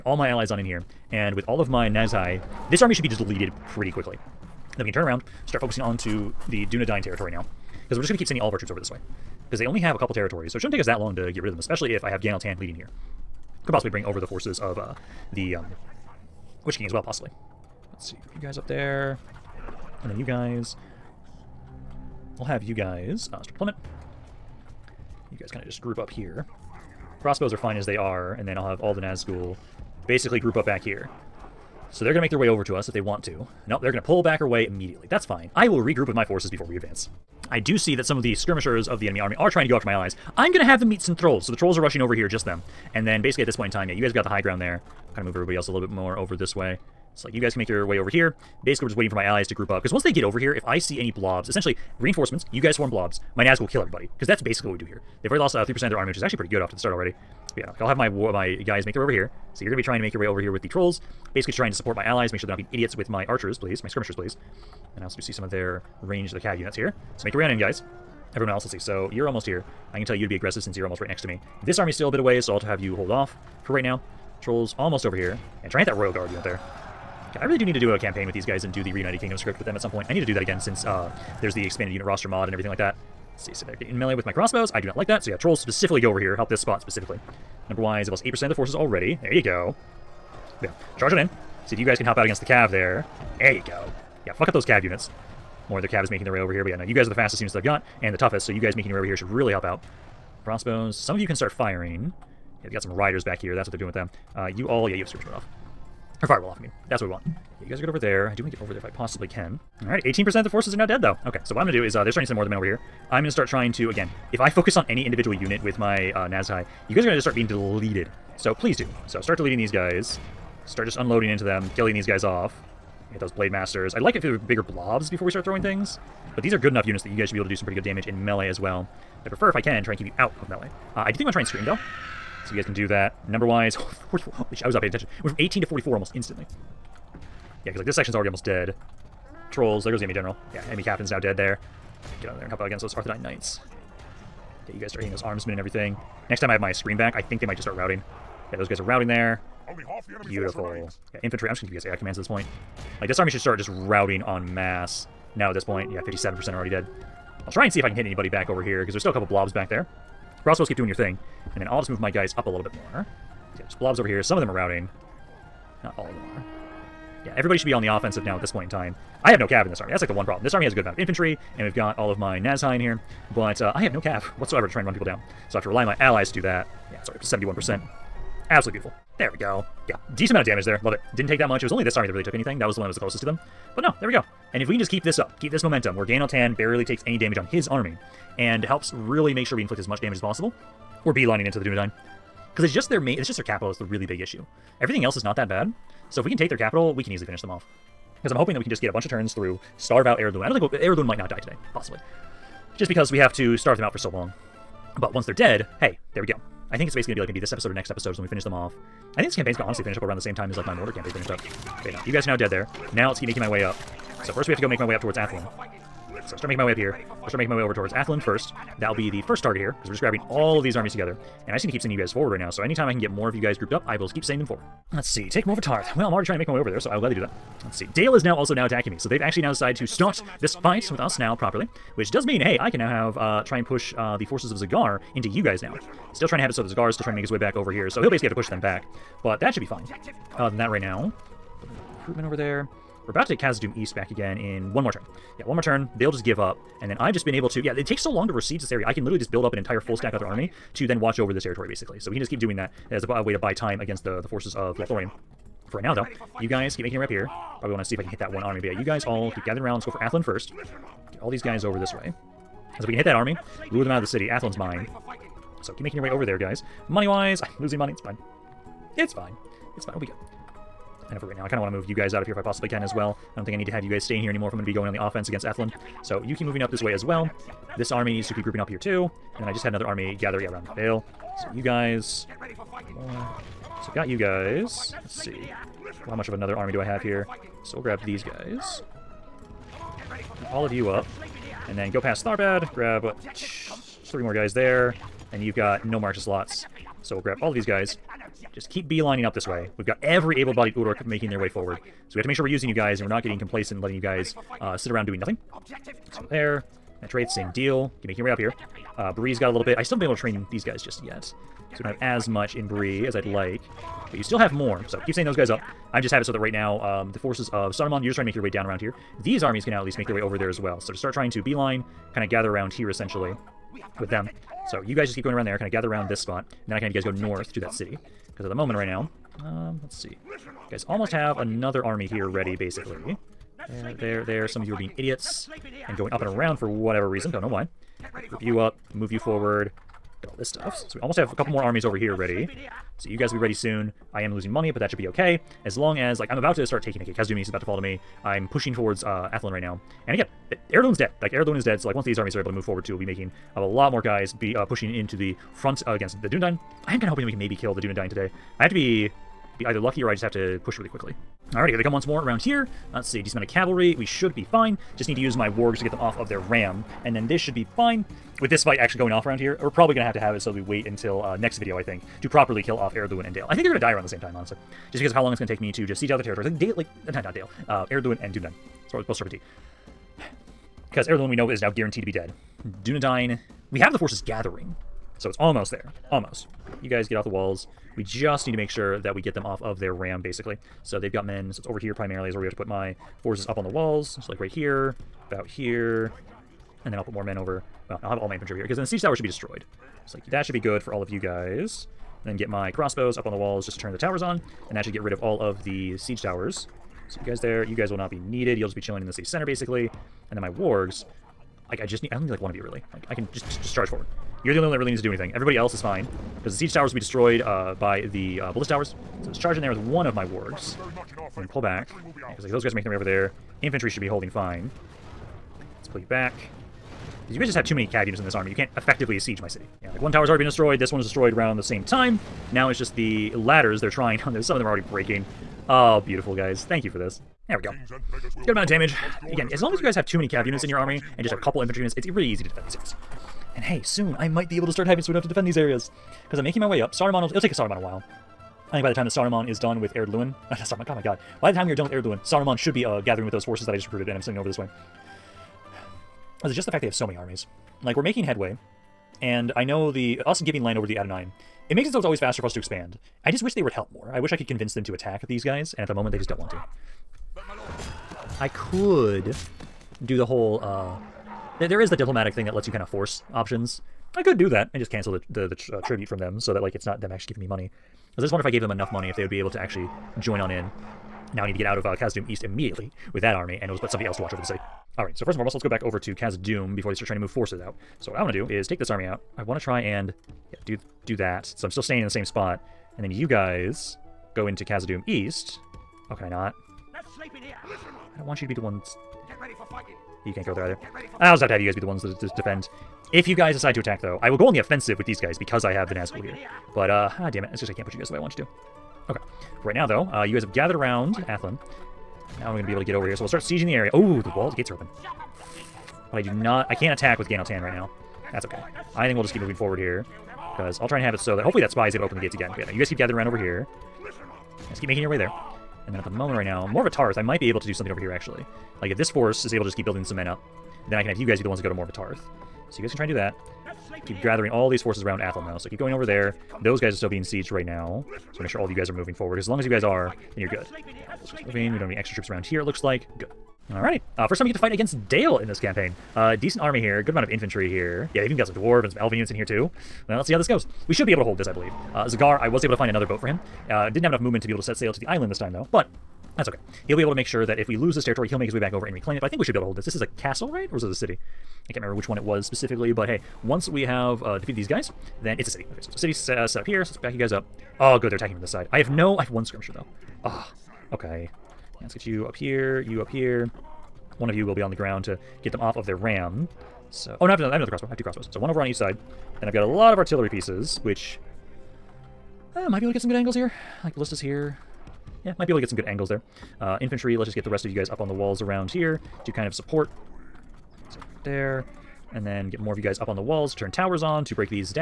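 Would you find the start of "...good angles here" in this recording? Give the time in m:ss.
9:43.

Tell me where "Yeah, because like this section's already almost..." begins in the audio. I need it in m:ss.
2:17.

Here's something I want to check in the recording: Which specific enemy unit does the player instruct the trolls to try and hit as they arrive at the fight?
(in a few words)
Royal Guard.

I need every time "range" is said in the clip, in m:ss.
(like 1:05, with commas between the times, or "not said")
1:06.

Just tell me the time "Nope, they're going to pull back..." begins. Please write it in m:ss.
0:33.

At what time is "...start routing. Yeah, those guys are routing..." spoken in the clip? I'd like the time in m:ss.
2:27.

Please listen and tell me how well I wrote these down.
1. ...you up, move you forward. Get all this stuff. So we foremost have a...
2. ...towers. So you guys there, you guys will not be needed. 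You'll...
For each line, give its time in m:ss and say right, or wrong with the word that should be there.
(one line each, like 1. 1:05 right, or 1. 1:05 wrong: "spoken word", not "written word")
1. 5:38 wrong: "almost", not "foremost"
2. 6:46 right.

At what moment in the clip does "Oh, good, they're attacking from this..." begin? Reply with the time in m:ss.
9:27.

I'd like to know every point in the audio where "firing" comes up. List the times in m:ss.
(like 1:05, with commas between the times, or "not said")
1:41.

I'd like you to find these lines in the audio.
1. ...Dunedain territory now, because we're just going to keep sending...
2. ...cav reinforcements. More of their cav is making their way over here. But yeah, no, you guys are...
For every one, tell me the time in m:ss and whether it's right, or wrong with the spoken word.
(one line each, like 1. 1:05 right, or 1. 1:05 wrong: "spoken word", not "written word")
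1. 0:06 right
2. 1:34 wrong: "units", not "reinforcements".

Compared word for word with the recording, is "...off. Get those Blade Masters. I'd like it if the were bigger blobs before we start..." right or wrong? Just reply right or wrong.
right.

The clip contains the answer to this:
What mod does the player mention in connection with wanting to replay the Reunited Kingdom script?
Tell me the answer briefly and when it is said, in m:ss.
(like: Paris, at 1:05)
expanded unit roster mod, at 1:21.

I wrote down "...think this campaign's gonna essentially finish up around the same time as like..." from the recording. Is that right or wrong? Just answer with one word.
wrong.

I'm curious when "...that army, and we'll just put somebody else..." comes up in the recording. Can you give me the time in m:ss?
8:03.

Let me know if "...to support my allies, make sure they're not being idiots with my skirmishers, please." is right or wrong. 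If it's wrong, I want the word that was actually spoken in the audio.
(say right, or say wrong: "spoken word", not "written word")
wrong: "archers", not "skirmishers".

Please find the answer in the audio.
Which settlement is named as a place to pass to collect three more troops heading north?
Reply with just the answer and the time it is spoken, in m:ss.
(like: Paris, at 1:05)
Tharbad, at 4:52.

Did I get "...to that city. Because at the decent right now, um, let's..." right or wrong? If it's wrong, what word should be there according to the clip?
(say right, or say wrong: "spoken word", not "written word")
wrong: "moment", not "decent".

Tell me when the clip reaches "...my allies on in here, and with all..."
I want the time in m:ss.
0:00.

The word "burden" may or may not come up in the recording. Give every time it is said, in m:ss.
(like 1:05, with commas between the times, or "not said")
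not said.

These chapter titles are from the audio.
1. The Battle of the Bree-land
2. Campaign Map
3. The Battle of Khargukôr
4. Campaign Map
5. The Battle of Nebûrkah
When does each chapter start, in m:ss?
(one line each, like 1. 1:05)
1. 0:13
2. 3:29
3. 6:24
4. 7:47
5. 9:25.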